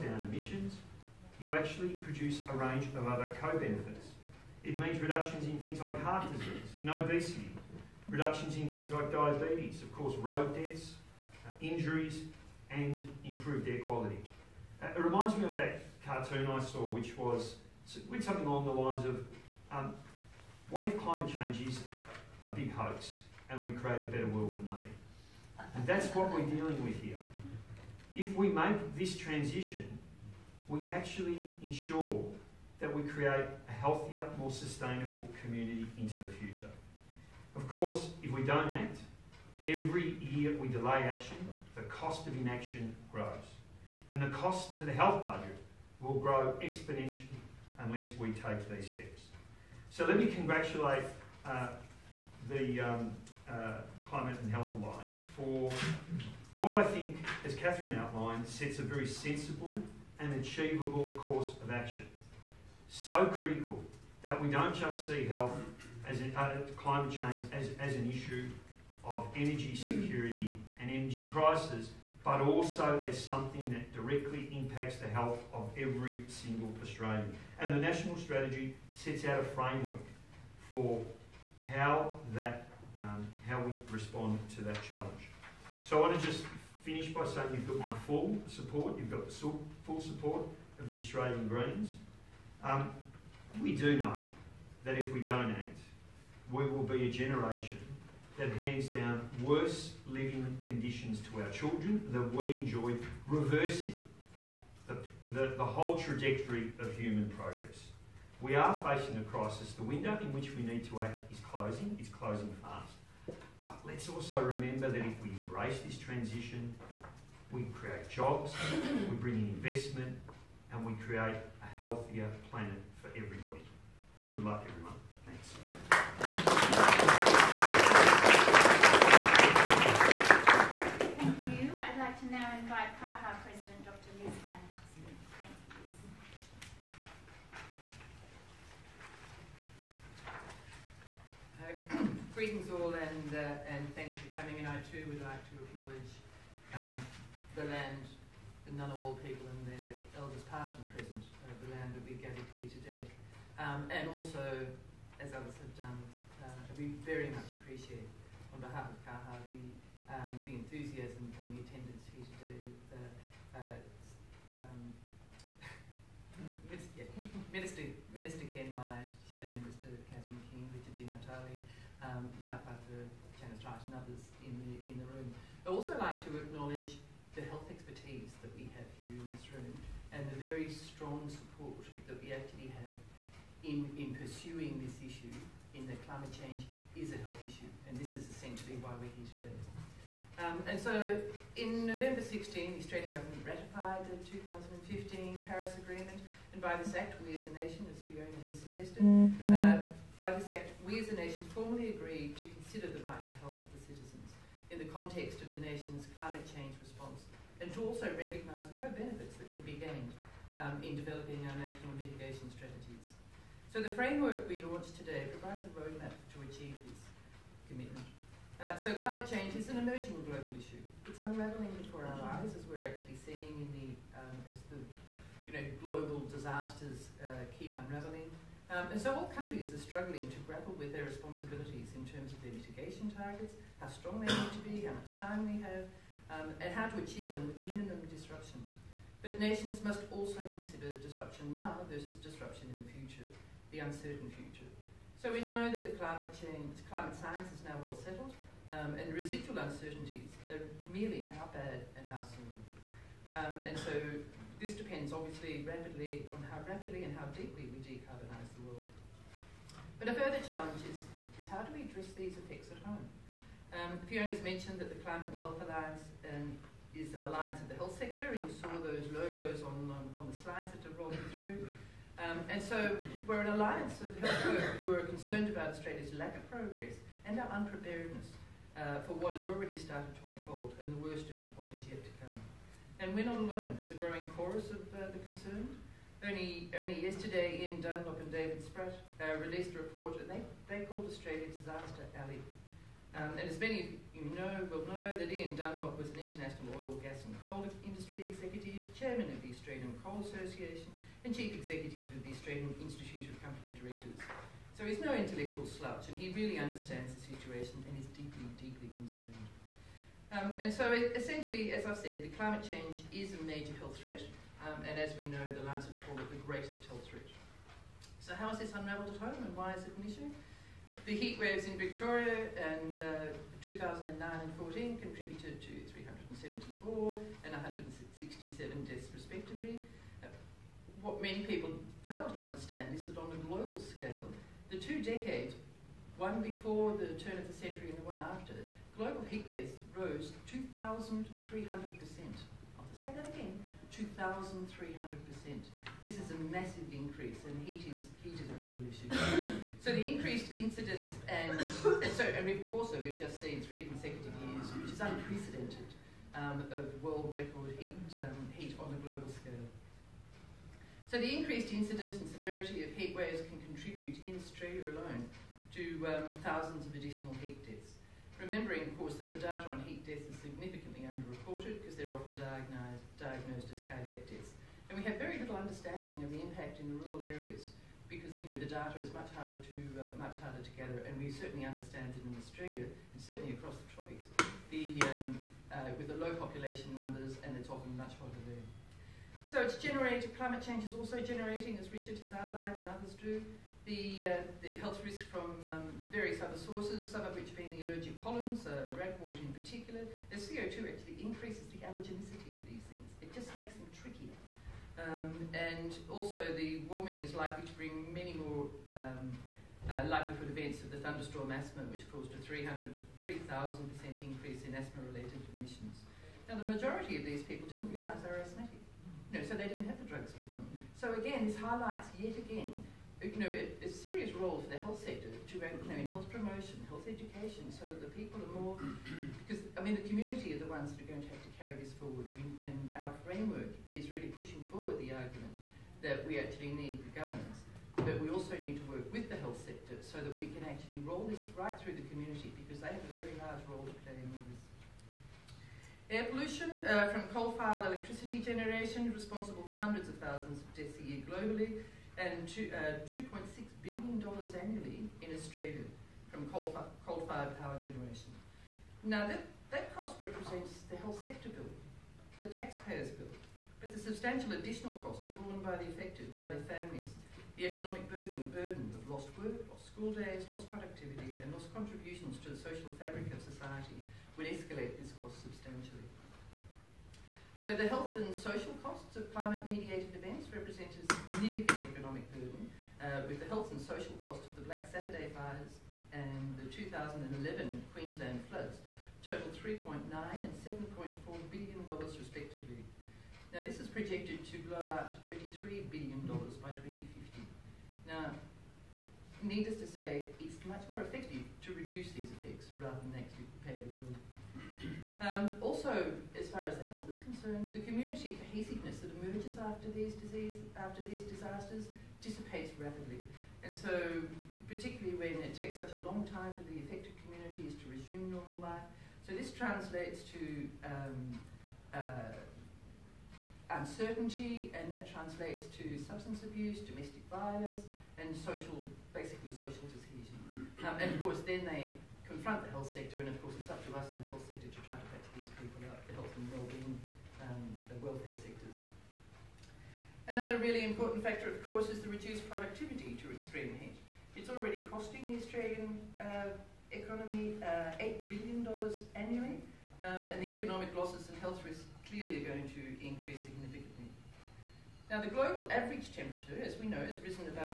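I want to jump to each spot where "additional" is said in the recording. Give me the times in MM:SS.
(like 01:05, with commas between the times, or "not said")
06:06, 07:44.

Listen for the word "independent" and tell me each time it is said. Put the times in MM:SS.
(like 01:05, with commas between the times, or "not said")
not said.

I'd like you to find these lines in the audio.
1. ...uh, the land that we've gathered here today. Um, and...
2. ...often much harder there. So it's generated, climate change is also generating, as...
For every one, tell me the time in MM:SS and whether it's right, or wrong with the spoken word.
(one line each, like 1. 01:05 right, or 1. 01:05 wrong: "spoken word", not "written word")
1. 02:31 right
2. 06:27 right.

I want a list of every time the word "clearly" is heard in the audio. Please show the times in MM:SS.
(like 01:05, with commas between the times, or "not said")
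09:12.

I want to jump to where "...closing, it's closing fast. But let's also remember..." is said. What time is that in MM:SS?
01:51.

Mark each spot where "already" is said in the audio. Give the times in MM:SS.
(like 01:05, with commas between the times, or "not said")
04:39, 09:04.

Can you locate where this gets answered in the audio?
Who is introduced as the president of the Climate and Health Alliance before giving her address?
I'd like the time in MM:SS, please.
02:13.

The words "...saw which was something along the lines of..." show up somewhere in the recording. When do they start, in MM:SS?
00:16.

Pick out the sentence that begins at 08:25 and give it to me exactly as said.
Um, also, as far as the health is concerned, the community cohesiveness that emerges after these disease, after these disasters dissipates rapidly.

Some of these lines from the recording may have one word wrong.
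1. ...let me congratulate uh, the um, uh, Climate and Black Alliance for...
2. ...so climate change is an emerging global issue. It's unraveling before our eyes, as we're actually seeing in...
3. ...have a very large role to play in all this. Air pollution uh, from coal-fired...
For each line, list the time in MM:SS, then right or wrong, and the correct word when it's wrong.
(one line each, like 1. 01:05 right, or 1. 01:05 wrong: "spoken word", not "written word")
1. 00:50 wrong: "Health", not "Black"
2. 03:38 right
3. 07:22 right.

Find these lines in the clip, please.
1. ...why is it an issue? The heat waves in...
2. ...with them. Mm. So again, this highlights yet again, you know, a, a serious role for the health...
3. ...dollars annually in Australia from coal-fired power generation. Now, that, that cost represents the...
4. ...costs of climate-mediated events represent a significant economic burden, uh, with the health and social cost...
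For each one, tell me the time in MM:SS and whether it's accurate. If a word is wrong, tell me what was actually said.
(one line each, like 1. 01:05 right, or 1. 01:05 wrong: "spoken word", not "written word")
1. 05:19 right
2. 07:00 right
3. 07:34 right
4. 07:58 right.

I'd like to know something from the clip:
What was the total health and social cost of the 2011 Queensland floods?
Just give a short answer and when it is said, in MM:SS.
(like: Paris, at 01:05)
7.4 billion dollars, at 08:10.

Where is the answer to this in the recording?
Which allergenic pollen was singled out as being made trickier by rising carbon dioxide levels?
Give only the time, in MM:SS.
06:38.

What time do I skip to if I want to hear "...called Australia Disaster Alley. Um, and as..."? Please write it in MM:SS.
04:50.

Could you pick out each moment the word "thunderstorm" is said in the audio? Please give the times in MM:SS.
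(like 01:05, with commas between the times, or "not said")
06:51.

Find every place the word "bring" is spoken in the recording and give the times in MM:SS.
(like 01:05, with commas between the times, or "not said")
01:59, 06:47.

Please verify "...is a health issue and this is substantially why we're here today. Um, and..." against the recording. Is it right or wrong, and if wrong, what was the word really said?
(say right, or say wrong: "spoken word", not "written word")
wrong: "essentially", not "substantially".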